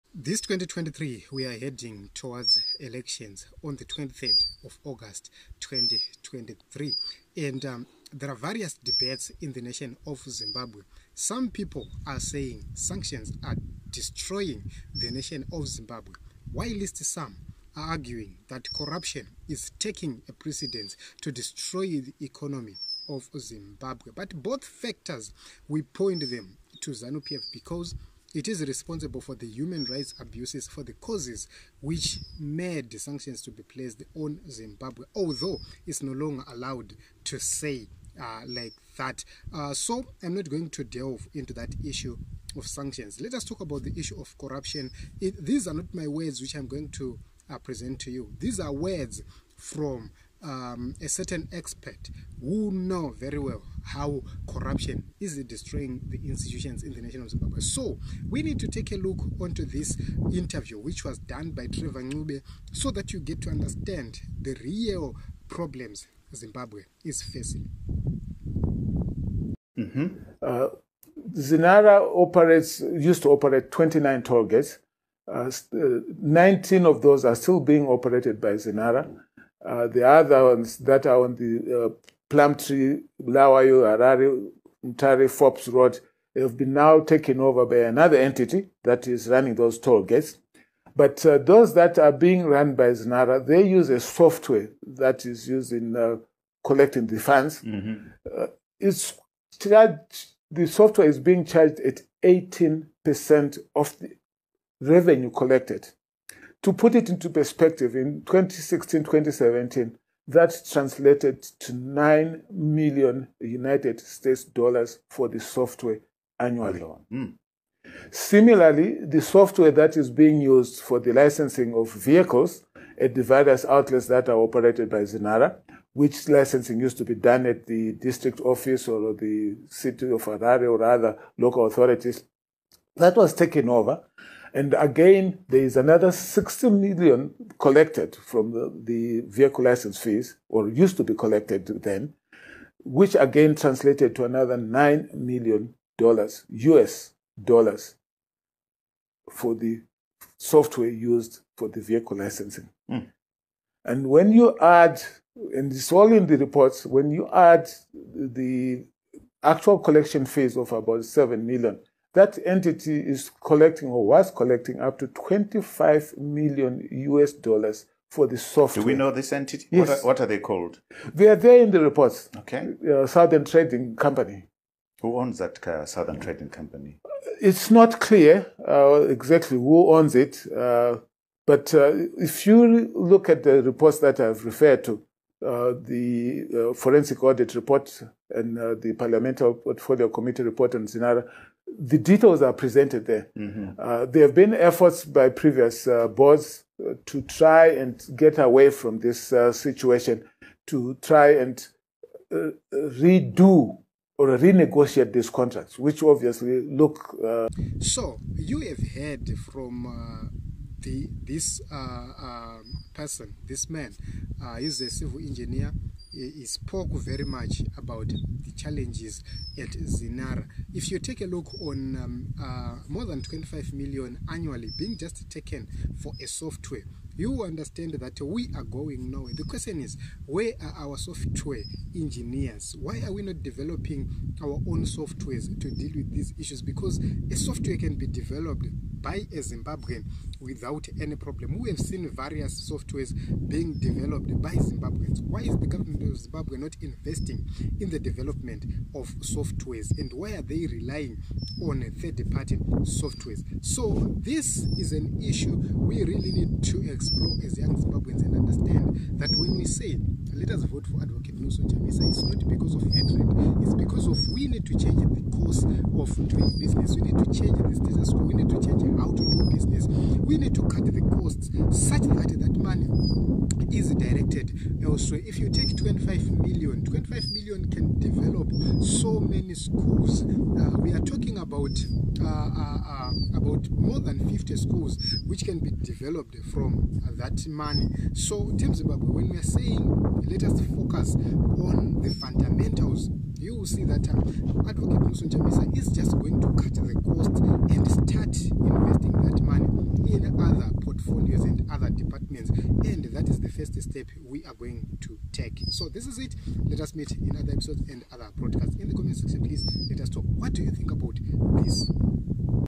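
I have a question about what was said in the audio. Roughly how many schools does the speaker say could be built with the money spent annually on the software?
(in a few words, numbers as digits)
More than 50.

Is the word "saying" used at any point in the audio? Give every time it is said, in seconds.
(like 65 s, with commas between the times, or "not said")
12 s, 289 s.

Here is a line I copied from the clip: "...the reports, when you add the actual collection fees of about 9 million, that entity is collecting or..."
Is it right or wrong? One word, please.
wrong.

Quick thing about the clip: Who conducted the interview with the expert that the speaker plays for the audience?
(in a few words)
Trevor Ncube.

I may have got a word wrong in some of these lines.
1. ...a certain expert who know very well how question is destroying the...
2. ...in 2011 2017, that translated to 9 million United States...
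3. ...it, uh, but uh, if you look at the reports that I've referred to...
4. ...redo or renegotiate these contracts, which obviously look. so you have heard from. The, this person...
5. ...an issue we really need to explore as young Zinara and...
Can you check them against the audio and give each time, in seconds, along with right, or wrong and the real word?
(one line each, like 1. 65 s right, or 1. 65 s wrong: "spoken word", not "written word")
1. 51 s wrong: "corruption", not "question"
2. 107 s wrong: "2016", not "2011"
3. 180 s right
4. 202 s right
5. 254 s wrong: "Zimbabweans", not "Zinara".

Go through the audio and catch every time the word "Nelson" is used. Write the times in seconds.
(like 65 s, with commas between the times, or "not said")
261 s, 295 s.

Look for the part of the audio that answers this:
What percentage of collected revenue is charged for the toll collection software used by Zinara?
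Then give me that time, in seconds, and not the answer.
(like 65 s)
102 s.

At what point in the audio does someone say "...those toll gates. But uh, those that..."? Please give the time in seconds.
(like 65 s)
89 s.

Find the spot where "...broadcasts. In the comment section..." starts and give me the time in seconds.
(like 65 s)
308 s.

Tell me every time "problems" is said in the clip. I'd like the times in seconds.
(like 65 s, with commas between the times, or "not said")
65 s, 241 s.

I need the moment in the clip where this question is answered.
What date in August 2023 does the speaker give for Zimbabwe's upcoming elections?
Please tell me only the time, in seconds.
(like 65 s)
3 s.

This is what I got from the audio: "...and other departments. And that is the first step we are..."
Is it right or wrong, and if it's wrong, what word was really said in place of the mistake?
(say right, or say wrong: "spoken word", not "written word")
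right.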